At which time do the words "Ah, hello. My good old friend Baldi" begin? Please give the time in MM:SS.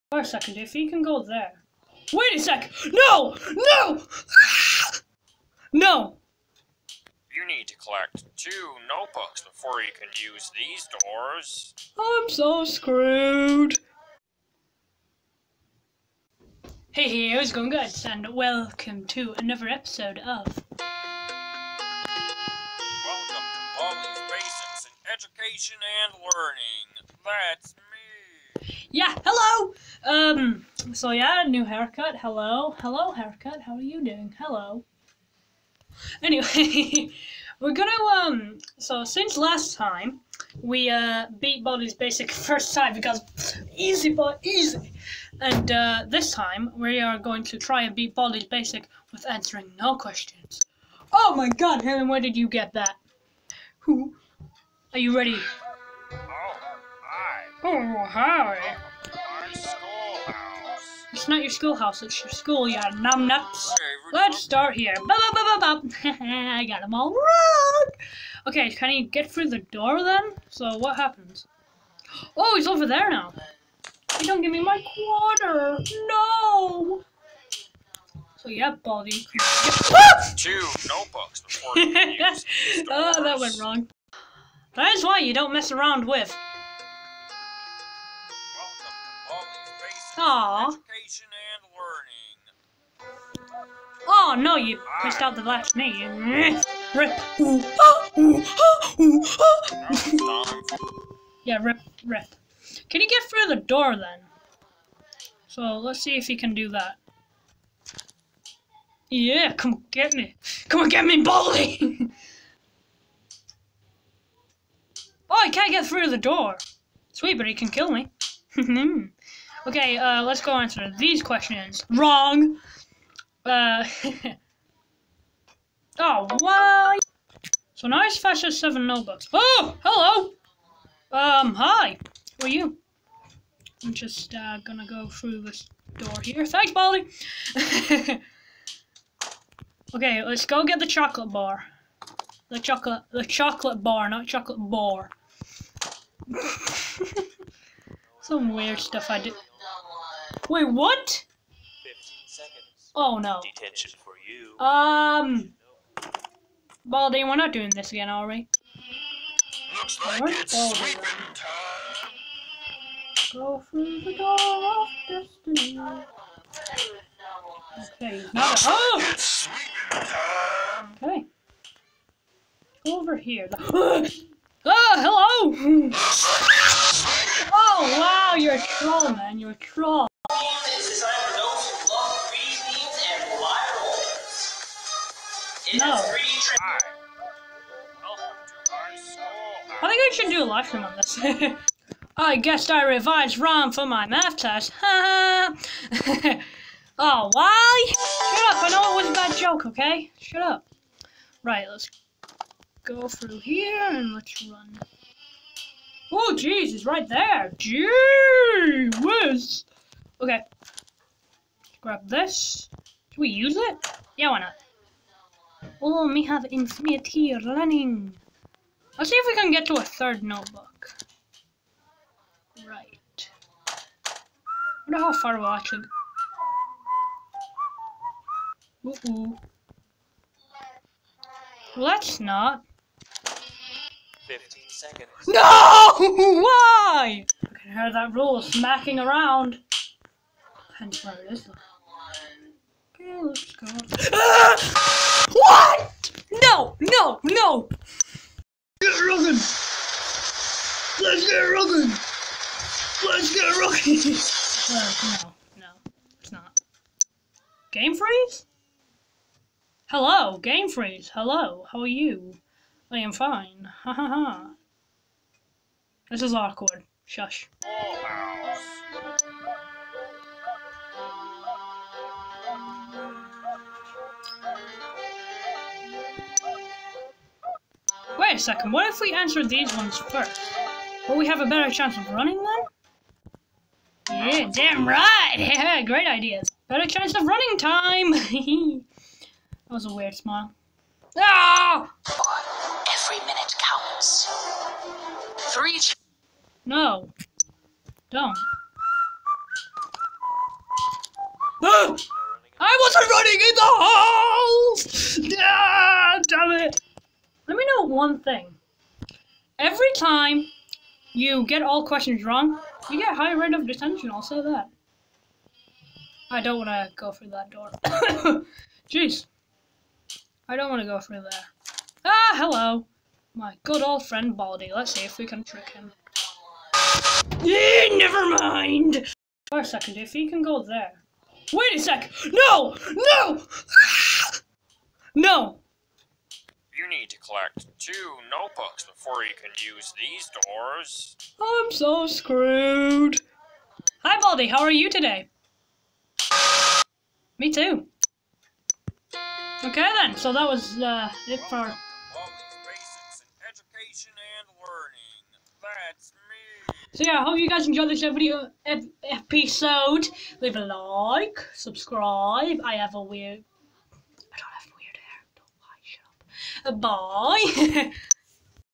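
05:22.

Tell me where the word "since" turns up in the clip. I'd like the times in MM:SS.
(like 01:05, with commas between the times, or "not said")
00:39.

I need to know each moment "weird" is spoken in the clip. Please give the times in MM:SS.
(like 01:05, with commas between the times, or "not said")
02:28, 04:49, 06:03.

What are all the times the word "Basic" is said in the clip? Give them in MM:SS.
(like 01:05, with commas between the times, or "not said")
00:24, 00:41, 00:48.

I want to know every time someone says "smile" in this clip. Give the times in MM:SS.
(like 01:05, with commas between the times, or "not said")
04:50.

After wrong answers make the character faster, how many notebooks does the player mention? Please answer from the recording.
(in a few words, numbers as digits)
7.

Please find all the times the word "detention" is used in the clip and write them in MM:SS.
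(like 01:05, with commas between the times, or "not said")
02:33, 05:13.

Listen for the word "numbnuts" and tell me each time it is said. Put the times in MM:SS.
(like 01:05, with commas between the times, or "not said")
01:02.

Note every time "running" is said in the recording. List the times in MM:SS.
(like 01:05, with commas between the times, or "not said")
03:37, 04:42, 04:47, 05:03.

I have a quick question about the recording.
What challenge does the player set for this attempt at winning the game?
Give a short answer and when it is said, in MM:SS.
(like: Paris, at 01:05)
answering no questions, at 00:49.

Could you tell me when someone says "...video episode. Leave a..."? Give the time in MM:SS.
05:58.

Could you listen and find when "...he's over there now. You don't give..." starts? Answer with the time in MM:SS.
01:12.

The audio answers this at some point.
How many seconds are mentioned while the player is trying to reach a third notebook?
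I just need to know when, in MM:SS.
03:54.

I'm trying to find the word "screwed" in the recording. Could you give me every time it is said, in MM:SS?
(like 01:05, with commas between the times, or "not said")
00:12, 05:42.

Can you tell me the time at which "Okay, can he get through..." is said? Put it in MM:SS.
01:08.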